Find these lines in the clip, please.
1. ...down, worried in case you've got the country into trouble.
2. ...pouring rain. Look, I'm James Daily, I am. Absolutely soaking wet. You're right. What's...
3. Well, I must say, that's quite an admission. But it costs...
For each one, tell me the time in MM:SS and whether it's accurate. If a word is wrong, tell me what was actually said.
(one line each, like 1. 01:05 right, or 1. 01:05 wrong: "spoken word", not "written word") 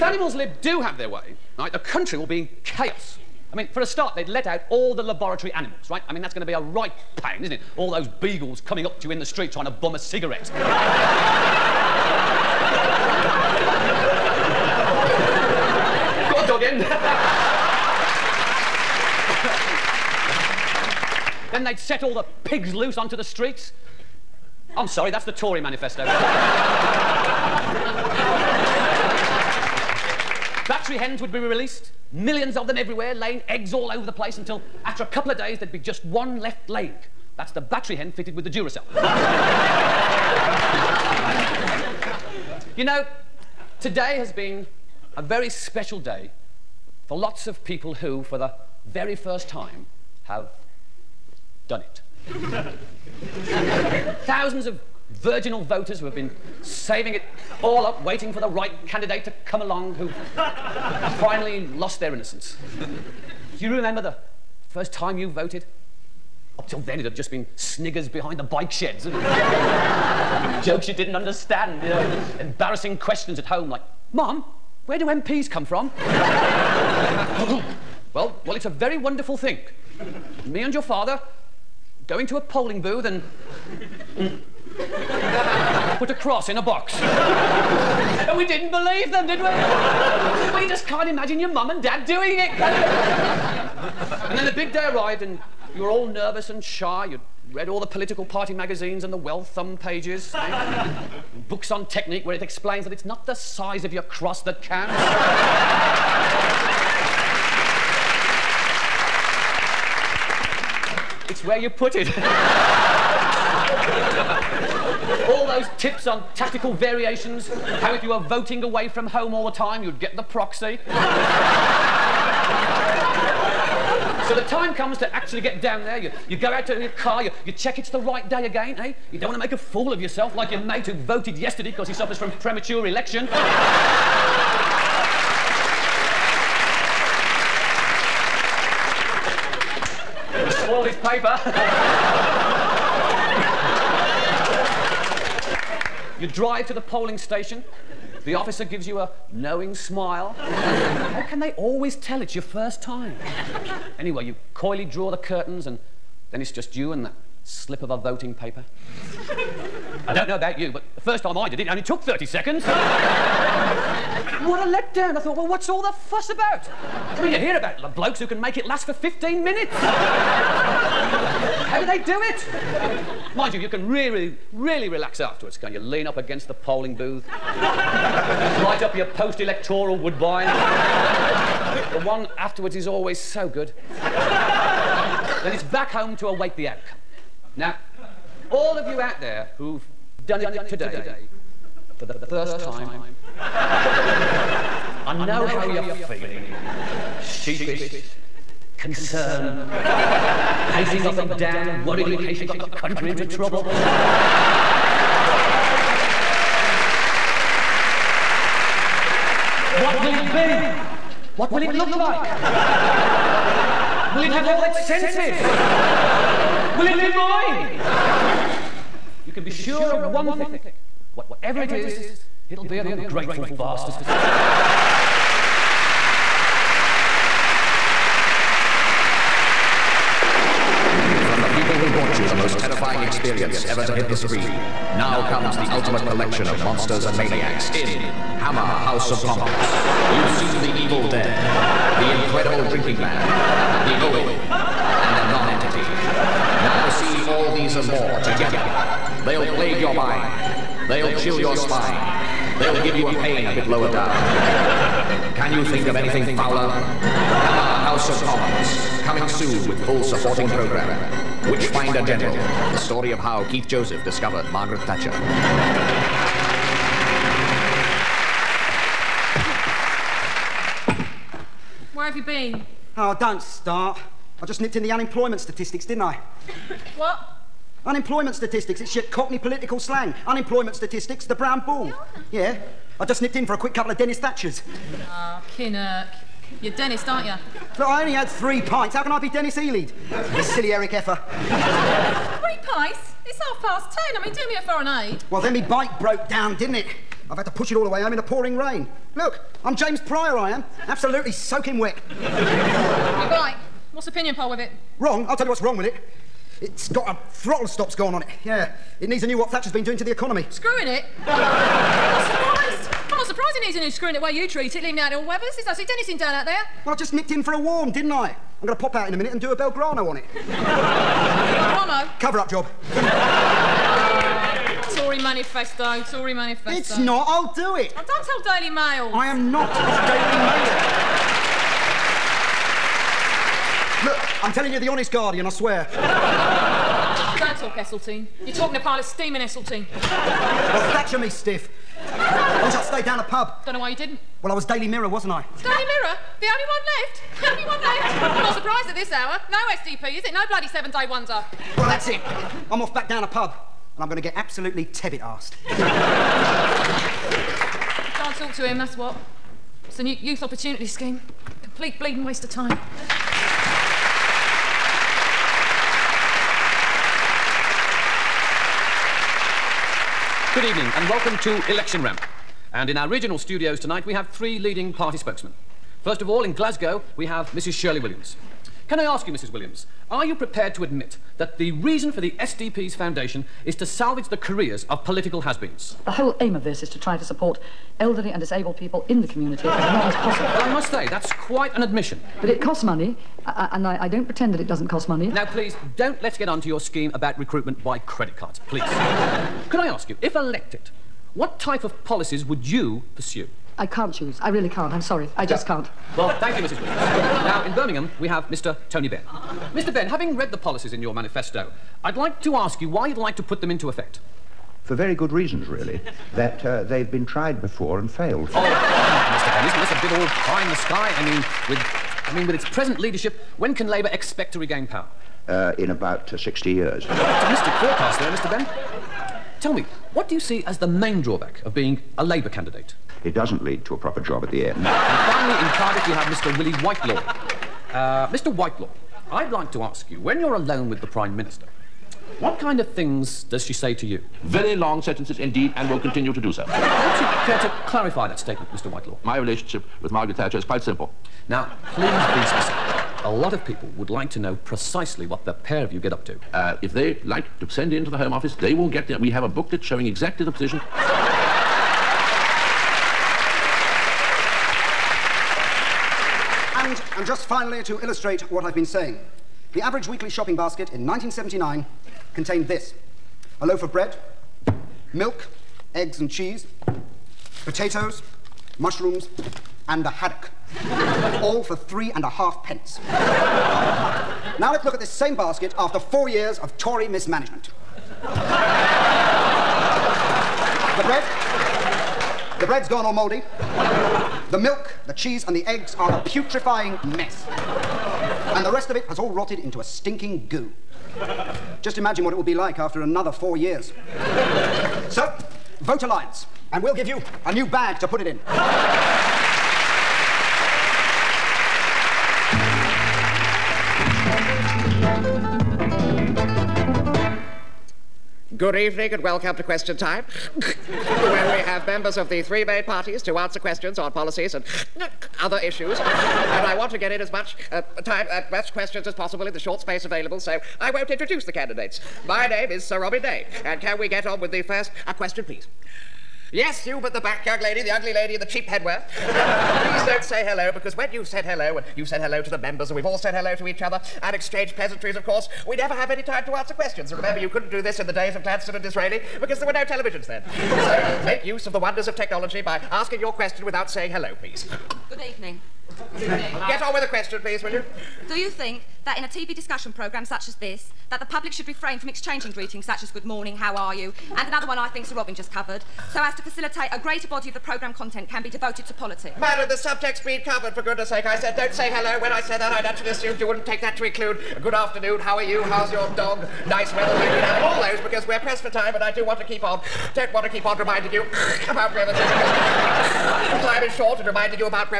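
1. 03:21 right
2. 04:58 wrong: "Prior", not "Daily"
3. 06:30 right.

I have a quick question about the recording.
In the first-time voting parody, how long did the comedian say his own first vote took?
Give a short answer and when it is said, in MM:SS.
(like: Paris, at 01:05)
30 seconds, at 02:42.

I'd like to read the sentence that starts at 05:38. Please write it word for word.
You're talking to pilot steaming Esseltine.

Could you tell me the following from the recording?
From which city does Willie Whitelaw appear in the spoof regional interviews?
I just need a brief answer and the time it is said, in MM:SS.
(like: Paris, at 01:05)
Cardiff, at 07:15.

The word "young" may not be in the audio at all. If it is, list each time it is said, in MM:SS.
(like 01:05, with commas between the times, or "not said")
08:57.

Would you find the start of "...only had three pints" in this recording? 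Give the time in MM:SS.
04:48.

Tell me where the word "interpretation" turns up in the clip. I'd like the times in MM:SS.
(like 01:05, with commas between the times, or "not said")
not said.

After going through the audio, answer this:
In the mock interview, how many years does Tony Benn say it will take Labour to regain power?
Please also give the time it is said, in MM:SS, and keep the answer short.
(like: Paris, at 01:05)
60 years, at 07:06.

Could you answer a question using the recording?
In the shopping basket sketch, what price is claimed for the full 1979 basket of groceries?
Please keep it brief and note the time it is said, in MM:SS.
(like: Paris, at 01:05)
three and a half pence, at 08:01.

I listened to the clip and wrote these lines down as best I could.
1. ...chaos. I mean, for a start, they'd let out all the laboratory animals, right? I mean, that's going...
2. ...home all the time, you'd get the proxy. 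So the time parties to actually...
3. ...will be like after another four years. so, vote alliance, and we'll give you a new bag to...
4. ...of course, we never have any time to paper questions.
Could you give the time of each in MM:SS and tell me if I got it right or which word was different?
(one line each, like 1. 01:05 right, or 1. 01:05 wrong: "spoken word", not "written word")
1. 00:02 right
2. 01:59 wrong: "comes", not "parties"
3. 08:22 right
4. 09:05 wrong: "answer", not "paper".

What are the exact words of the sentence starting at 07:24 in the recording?
very long sentences indeed and will continue to do so.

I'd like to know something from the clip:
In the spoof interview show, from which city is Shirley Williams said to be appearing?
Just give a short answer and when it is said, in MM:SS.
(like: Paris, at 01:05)
Glasgow, at 06:16.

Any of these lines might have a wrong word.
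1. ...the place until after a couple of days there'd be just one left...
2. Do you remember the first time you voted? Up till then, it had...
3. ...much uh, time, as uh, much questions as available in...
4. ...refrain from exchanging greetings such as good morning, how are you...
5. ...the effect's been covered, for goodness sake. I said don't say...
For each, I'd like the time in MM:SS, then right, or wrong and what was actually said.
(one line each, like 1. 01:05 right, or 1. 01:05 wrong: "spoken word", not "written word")
1. 00:34 right
2. 01:02 right
3. 08:47 wrong: "possible", not "available"
4. 09:21 right
5. 09:29 wrong: "subject", not "effect".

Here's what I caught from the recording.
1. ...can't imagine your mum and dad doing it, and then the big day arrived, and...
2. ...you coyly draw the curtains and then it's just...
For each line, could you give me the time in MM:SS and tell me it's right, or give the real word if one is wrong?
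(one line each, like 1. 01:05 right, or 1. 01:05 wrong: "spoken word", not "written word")
1. 01:30 right
2. 02:34 right.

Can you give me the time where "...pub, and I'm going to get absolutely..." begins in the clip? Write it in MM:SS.
05:53.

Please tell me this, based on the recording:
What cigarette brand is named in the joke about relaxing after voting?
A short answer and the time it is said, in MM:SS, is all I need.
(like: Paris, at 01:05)
Woodbine, at 02:59.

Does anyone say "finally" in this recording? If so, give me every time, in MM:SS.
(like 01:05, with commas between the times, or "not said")
01:01, 07:14, 07:47.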